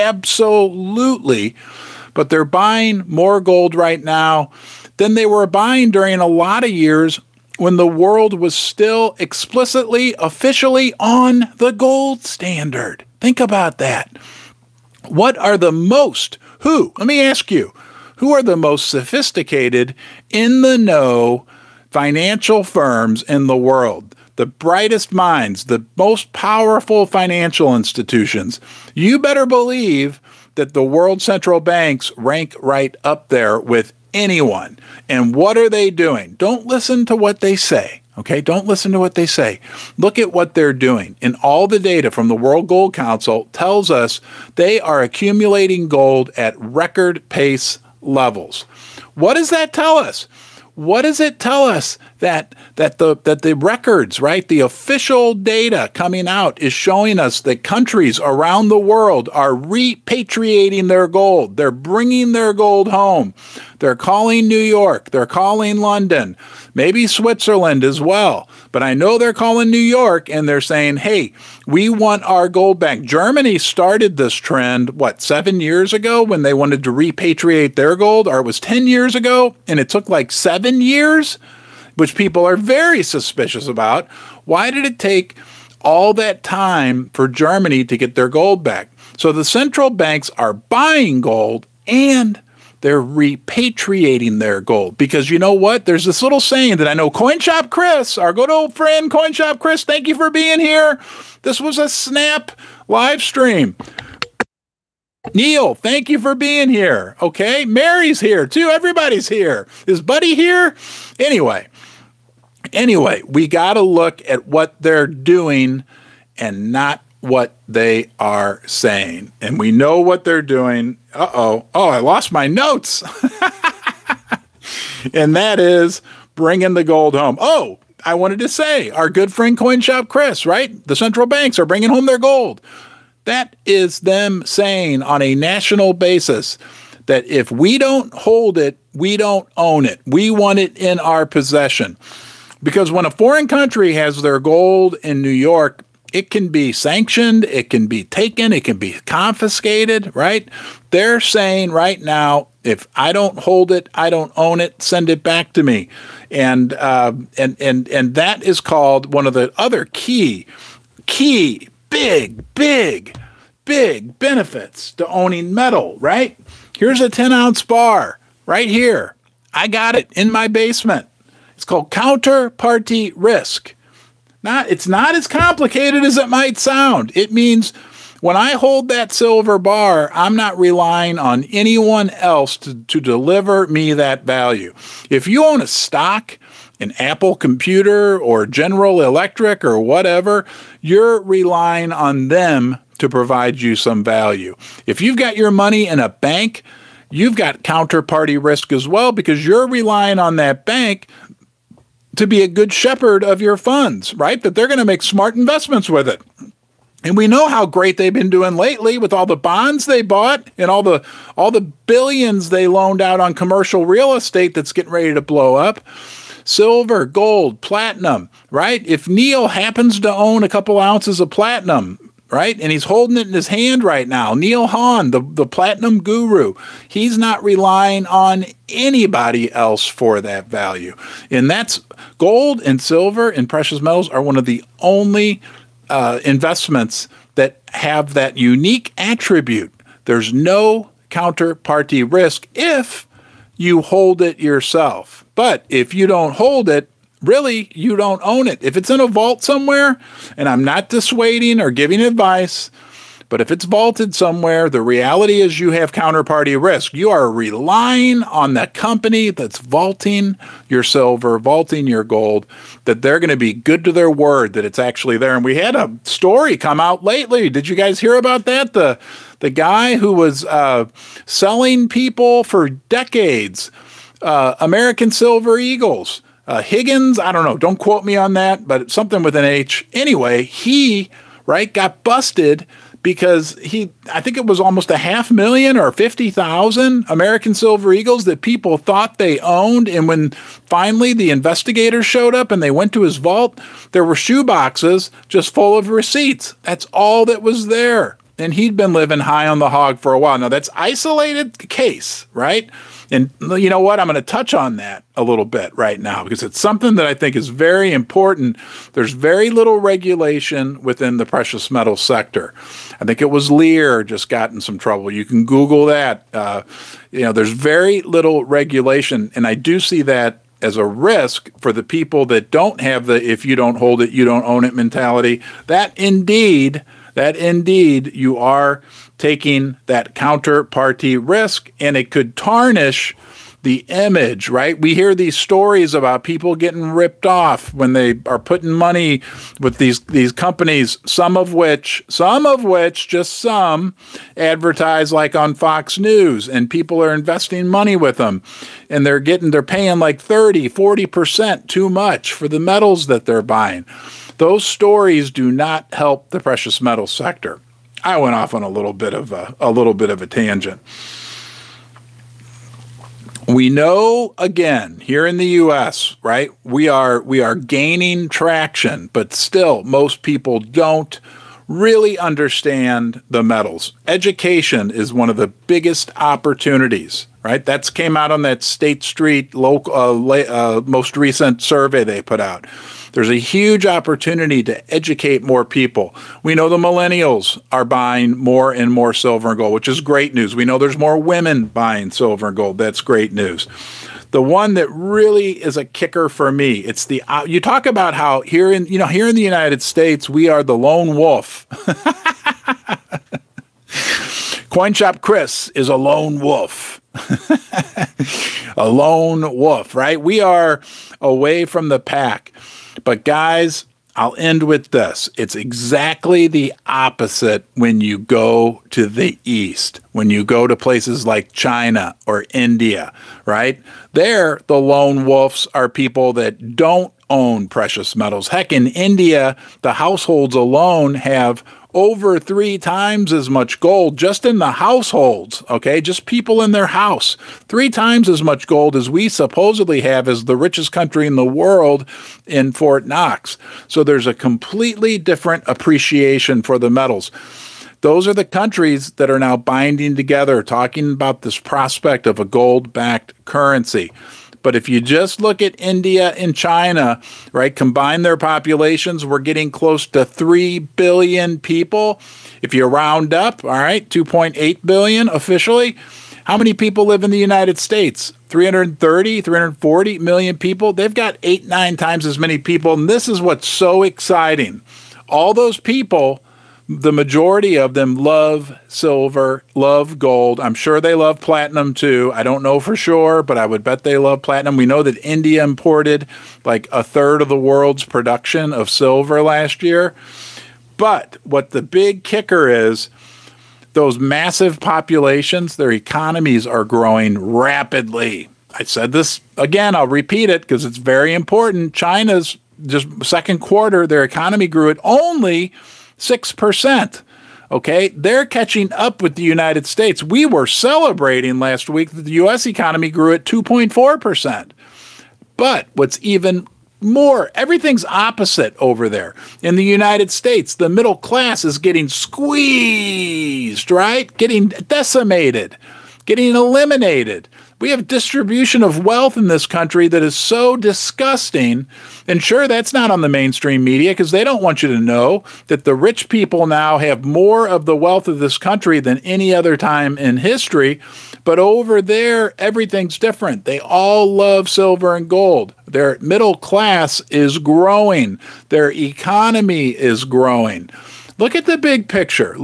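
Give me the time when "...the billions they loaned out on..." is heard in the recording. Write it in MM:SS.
03:31.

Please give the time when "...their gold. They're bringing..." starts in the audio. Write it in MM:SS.
01:00.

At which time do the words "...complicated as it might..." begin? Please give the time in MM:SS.
02:55.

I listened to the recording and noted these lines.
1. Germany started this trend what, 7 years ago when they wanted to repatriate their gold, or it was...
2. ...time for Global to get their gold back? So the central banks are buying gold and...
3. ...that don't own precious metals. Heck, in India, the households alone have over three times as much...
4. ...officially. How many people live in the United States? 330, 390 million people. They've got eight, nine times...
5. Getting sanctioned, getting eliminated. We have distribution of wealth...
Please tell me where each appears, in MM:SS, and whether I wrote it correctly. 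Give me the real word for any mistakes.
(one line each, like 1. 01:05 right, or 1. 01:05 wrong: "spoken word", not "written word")
1. 01:12 right
2. 01:26 wrong: "Germany", not "Global"
3. 07:06 right
4. 07:45 wrong: "340", not "390"
5. 08:44 wrong: "decimated", not "sanctioned".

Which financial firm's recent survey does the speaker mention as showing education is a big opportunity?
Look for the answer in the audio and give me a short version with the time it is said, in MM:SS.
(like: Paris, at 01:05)
State Street Global, at 06:18.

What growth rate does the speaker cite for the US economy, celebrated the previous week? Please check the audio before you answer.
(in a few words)
2.4%.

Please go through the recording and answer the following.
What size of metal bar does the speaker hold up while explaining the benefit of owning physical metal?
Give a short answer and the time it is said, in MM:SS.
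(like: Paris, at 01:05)
10 ounce, at 02:47.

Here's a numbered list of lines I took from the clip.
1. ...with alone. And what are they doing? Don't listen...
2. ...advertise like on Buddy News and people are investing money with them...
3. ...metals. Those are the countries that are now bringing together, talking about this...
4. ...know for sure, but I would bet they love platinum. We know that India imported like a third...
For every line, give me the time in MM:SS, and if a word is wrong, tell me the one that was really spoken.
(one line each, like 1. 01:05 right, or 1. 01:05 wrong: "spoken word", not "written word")
1. 00:33 wrong: "anyone", not "alone"
2. 05:44 wrong: "Fox", not "Buddy"
3. 07:26 wrong: "binding", not "bringing"
4. 08:02 right.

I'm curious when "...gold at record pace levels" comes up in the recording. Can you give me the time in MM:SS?
00:45.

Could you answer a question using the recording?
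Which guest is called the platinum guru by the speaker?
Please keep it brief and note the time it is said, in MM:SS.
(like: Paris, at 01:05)
Neil Hahn, at 03:44.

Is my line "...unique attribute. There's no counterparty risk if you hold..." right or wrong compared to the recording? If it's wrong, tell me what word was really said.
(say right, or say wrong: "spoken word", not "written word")
right.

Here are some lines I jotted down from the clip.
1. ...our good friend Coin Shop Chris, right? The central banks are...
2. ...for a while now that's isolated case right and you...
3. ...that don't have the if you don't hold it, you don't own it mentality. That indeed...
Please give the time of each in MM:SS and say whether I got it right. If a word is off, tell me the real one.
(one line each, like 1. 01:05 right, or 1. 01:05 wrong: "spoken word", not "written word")
1. 02:08 right
2. 04:59 right
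3. 05:22 right.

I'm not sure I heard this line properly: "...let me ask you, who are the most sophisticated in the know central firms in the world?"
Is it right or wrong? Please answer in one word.
wrong.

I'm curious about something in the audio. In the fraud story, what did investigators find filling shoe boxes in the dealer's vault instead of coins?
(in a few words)
Receipts.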